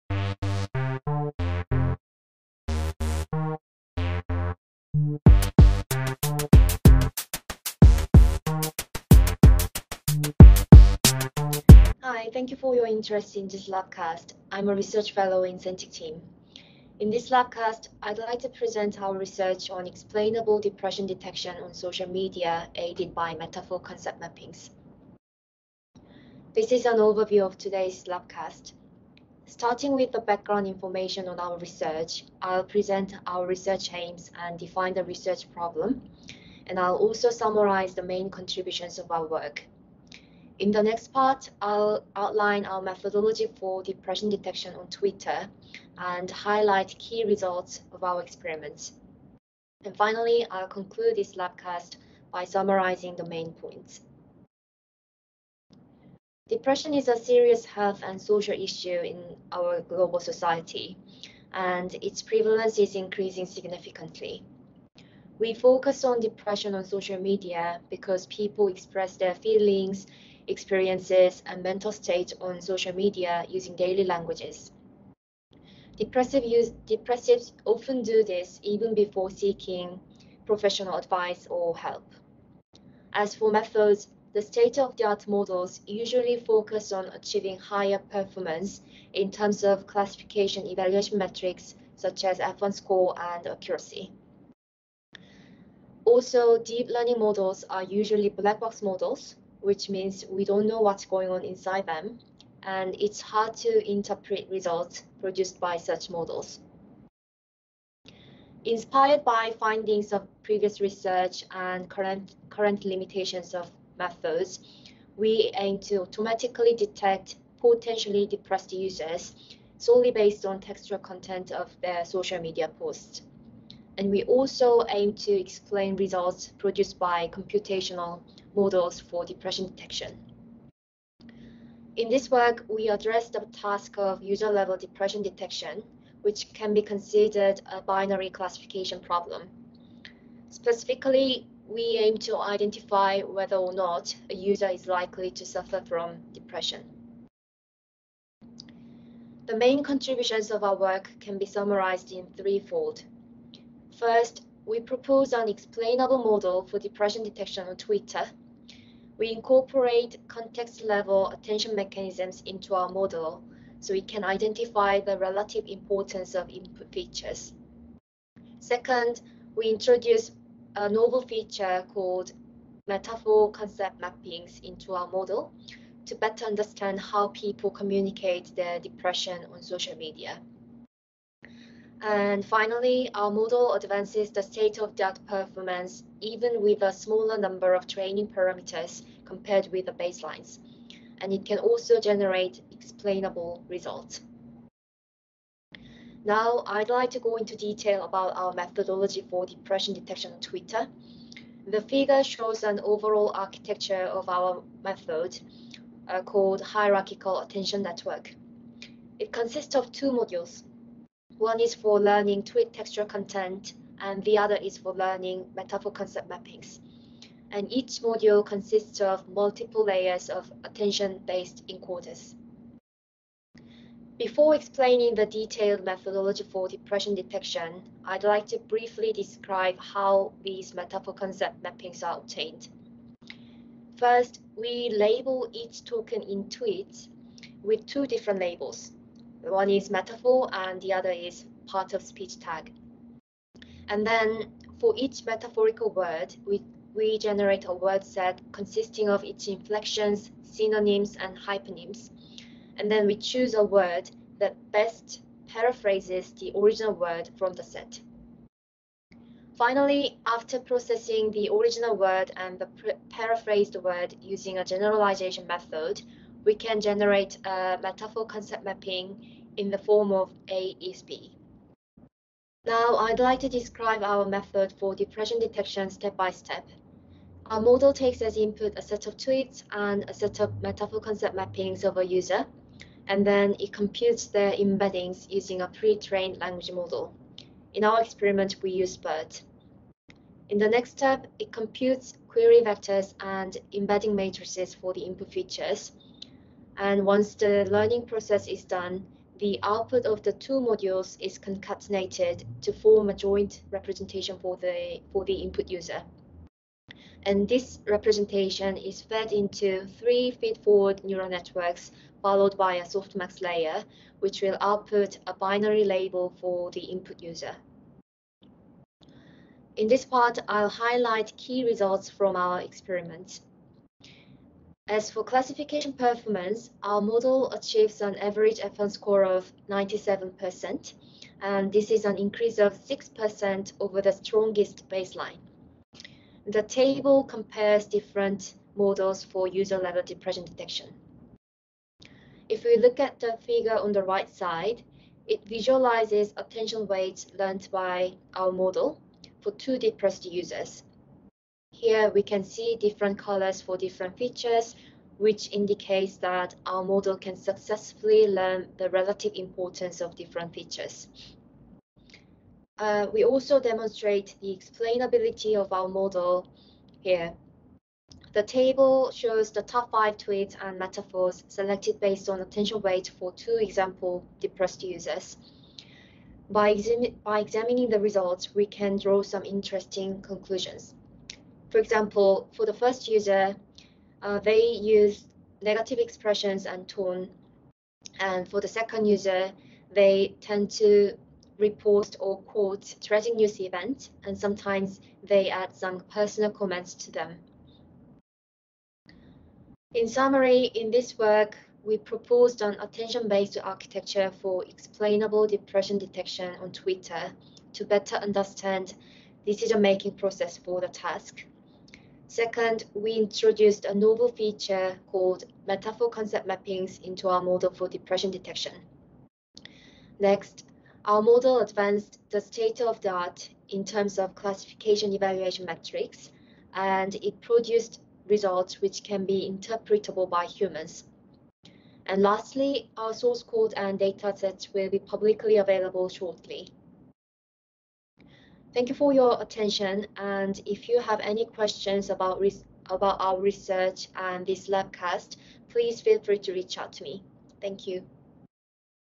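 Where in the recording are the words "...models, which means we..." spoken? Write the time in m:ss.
1:38.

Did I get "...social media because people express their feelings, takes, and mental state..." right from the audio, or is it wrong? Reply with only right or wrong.
wrong.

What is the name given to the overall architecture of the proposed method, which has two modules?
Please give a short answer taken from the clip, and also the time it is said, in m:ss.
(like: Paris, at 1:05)
Hierarchical Attention Network, at 3:26.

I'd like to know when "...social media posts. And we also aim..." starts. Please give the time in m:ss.
2:02.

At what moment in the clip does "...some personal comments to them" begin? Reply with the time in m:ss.
6:35.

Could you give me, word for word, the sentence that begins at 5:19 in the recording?
In this part, I'll highlight key results from our experiments.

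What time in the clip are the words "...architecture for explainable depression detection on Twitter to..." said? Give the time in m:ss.
6:43.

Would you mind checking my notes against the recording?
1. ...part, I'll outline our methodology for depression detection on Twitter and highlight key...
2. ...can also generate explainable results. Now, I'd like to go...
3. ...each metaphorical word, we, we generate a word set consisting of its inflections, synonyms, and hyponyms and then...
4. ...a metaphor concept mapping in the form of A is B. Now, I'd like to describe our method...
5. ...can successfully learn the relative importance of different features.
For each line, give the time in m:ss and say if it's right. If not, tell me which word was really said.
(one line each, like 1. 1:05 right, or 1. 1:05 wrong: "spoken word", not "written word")
1. 0:41 right
2. 3:11 right
3. 4:04 right
4. 4:27 right
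5. 5:57 right.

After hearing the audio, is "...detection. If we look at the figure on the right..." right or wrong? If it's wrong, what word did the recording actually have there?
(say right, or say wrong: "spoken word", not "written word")
right.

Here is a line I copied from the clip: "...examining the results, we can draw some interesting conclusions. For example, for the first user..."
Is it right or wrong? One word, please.
right.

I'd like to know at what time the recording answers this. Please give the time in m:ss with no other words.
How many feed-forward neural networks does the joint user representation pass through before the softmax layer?
5:09.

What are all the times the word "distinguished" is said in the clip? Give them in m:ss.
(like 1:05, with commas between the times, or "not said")
not said.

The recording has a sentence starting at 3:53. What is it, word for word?
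First, we label each token in tweets with two different labels.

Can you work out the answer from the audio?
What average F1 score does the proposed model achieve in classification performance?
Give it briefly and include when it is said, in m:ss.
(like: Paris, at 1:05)
97%, at 5:29.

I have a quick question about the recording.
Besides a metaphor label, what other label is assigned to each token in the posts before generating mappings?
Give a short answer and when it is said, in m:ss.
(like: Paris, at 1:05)
part of speech tag, at 4:01.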